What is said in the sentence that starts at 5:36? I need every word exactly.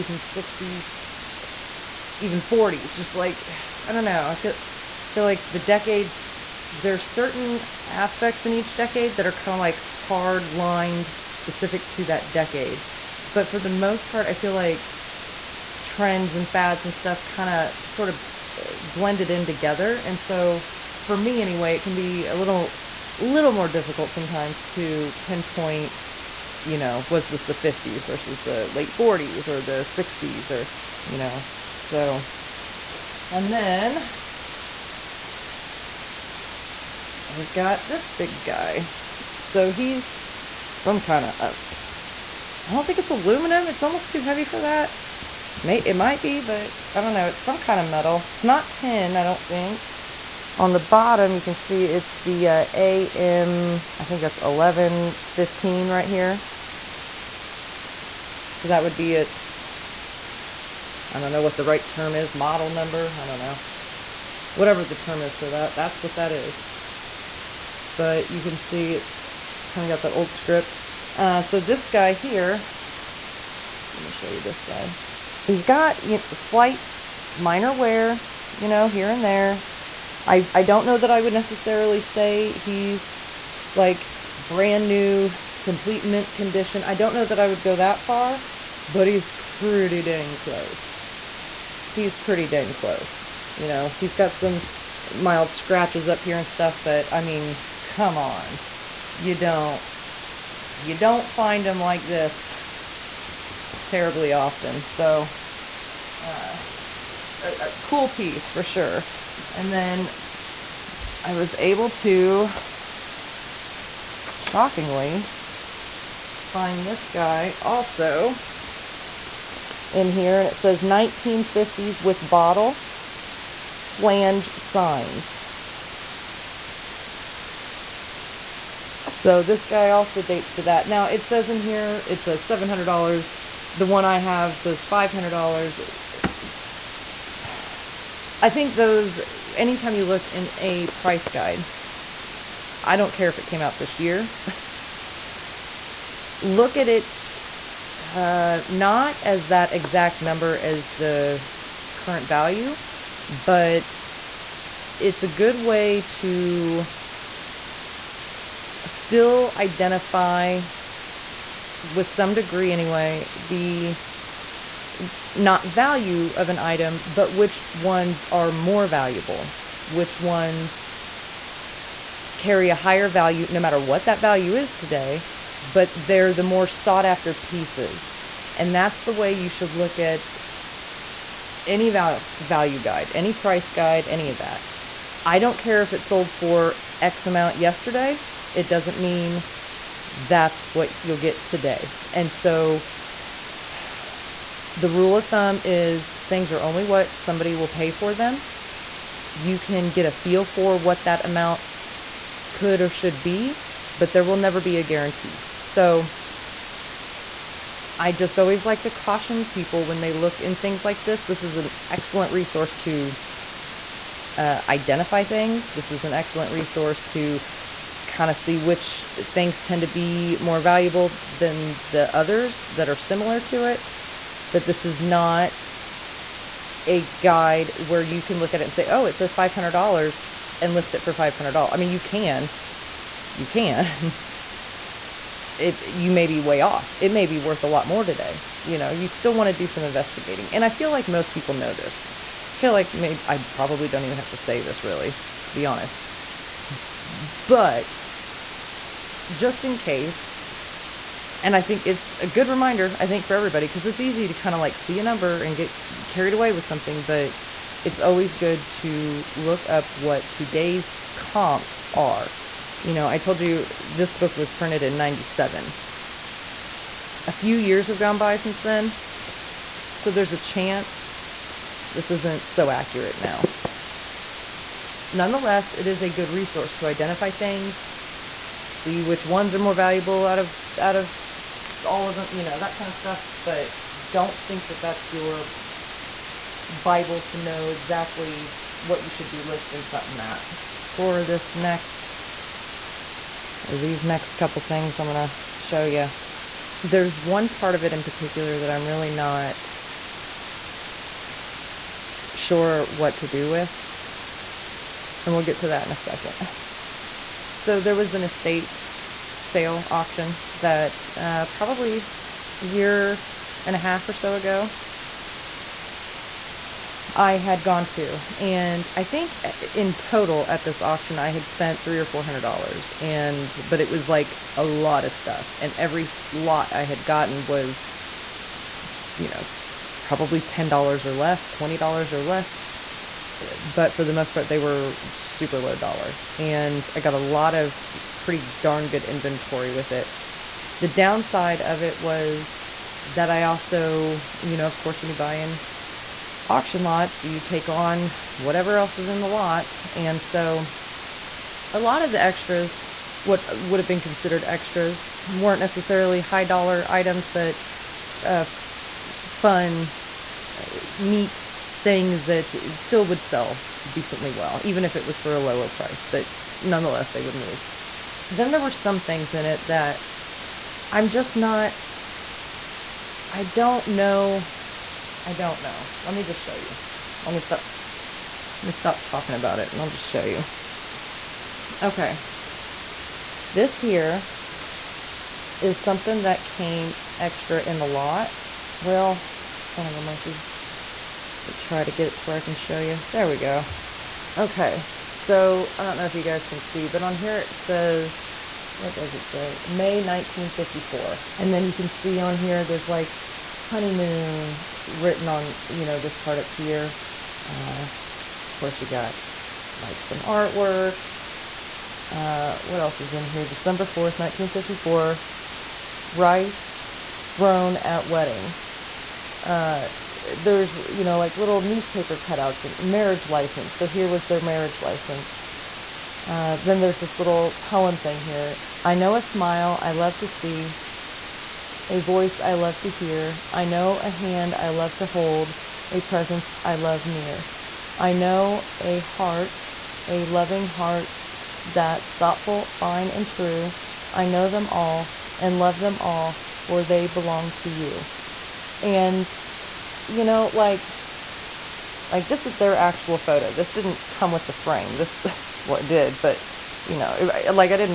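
And I got a lot of pretty darn good inventory with it.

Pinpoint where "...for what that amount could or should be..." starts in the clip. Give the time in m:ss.
3:20.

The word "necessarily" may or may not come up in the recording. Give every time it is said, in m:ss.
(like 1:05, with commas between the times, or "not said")
1:21, 5:55.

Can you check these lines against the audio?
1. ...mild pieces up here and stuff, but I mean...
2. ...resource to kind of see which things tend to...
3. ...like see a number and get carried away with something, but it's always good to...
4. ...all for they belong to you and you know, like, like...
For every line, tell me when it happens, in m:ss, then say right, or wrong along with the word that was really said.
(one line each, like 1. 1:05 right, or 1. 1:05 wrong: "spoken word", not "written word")
1. 1:35 wrong: "scratches", not "pieces"
2. 3:36 right
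3. 4:14 right
4. 7:25 right.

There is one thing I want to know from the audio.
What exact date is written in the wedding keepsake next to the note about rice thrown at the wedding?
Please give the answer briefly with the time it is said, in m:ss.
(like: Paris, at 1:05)
December 4, 1954, at 6:53.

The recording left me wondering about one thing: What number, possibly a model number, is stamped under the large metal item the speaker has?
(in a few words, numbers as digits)
1115.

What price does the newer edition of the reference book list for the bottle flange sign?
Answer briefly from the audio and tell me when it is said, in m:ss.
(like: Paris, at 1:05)
$700, at 2:12.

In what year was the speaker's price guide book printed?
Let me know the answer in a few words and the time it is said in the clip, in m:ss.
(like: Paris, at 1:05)
1997, at 4:24.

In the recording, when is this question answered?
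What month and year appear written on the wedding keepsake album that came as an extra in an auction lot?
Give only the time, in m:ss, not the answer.
6:39.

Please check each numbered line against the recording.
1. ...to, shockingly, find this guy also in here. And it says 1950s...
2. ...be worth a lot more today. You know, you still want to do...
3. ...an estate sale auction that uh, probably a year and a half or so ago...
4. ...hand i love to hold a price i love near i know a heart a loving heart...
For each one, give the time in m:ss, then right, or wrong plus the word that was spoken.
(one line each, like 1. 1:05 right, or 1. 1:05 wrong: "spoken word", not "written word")
1. 1:51 right
2. 3:57 right
3. 5:08 right
4. 7:14 wrong: "presence", not "price".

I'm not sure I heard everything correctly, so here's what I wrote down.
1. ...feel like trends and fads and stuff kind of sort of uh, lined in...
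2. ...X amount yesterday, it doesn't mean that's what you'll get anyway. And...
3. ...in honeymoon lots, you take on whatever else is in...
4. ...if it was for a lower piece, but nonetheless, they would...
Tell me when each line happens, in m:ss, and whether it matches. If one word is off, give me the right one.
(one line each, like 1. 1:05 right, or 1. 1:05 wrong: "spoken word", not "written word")
1. 0:14 wrong: "blended", not "lined"
2. 3:07 wrong: "today", not "anyway"
3. 5:45 wrong: "auction", not "honeymoon"
4. 6:04 wrong: "price", not "piece".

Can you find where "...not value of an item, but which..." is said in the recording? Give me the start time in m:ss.
2:45.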